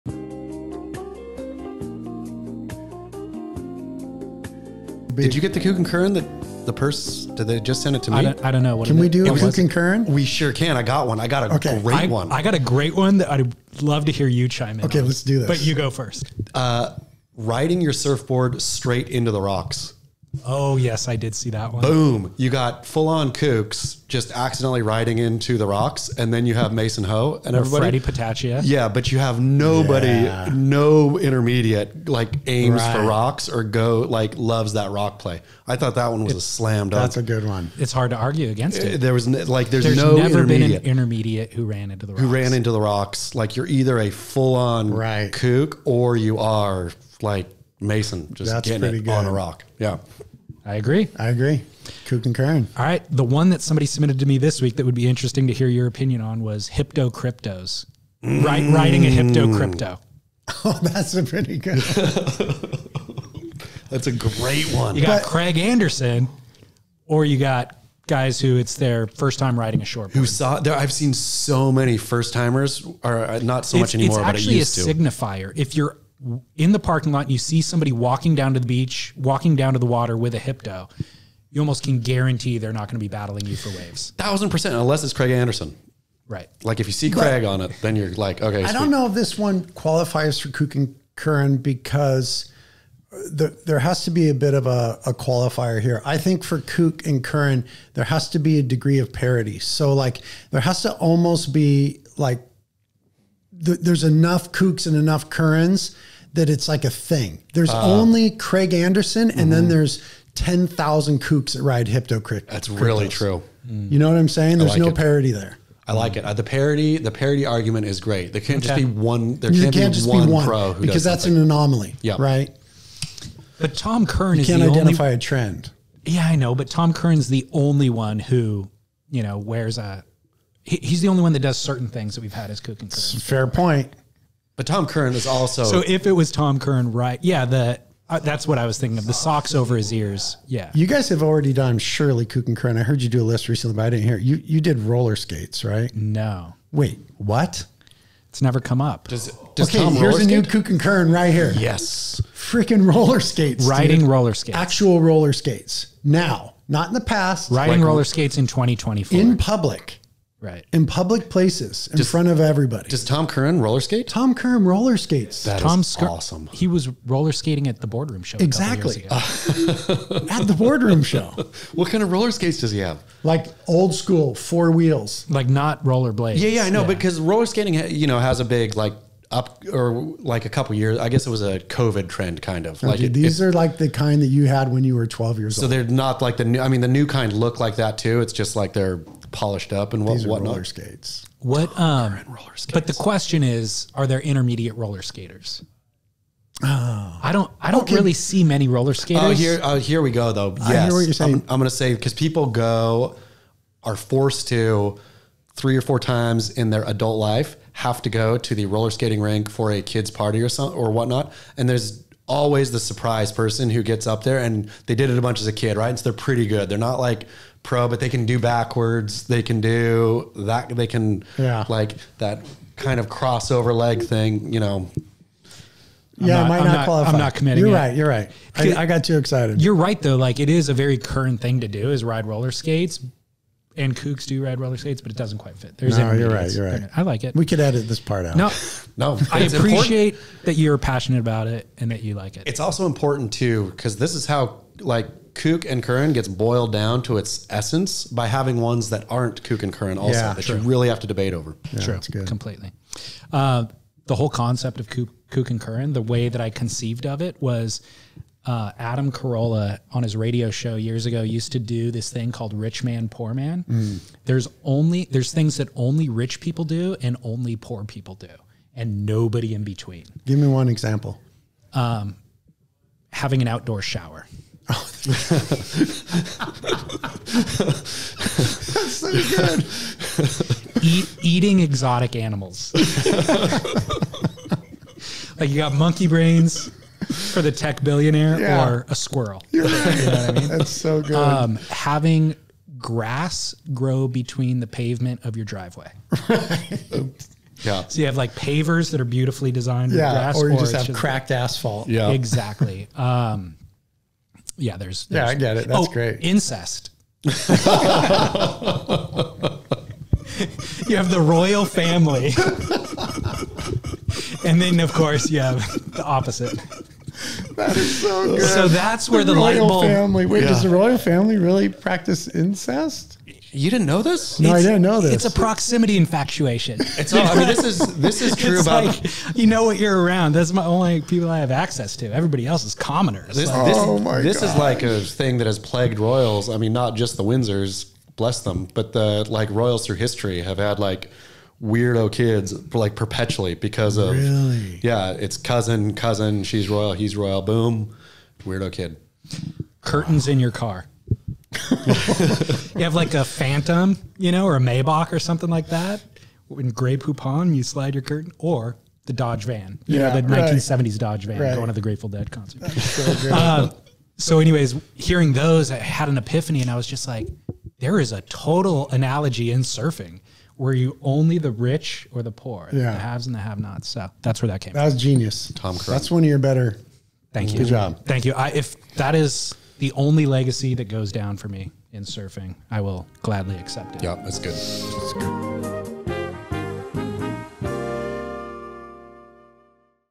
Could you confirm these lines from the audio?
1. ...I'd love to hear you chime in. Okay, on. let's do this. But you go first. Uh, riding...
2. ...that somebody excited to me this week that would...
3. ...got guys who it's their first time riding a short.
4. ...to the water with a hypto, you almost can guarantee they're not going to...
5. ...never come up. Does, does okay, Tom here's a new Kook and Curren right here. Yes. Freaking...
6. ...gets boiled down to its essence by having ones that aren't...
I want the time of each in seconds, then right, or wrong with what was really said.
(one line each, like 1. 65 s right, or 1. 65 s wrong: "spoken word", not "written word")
1. 13 s right
2. 53 s wrong: "submitted", not "excited"
3. 67 s right
4. 79 s right
5. 148 s right
6. 246 s right.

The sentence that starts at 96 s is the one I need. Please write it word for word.
I think for Kook and Curren, there has to be a degree of parity.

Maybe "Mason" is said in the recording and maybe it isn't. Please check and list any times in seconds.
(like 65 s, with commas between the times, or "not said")
26 s, 47 s.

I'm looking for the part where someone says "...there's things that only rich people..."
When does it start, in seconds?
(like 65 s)
265 s.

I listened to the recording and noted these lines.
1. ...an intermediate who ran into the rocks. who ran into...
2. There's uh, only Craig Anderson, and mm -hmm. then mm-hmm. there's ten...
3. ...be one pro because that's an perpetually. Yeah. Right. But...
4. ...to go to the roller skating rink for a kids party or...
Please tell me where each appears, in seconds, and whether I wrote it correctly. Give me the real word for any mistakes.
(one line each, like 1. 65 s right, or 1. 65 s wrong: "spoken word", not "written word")
1. 40 s right
2. 107 s right
3. 120 s wrong: "anomaly", not "perpetually"
4. 208 s right.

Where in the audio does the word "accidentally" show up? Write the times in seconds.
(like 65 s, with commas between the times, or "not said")
24 s.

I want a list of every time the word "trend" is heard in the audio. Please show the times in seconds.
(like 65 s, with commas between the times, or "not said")
125 s, 182 s.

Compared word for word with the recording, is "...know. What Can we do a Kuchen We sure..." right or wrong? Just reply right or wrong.
right.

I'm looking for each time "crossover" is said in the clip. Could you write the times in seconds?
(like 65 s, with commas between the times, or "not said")
223 s.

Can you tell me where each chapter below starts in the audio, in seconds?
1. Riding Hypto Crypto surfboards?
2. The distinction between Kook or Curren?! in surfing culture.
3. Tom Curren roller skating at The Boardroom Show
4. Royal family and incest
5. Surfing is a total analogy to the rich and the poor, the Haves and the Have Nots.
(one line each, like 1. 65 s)
1. 52 s
2. 96 s
3. 143 s
4. 287 s
5. 341 s.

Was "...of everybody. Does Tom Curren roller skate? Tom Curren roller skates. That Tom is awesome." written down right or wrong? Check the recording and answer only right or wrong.
right.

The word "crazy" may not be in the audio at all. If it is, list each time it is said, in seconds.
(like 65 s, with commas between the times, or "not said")
not said.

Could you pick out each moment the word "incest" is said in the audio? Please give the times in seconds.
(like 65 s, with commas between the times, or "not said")
306 s, 322 s.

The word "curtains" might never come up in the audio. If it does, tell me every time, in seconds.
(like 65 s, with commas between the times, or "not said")
349 s, 358 s.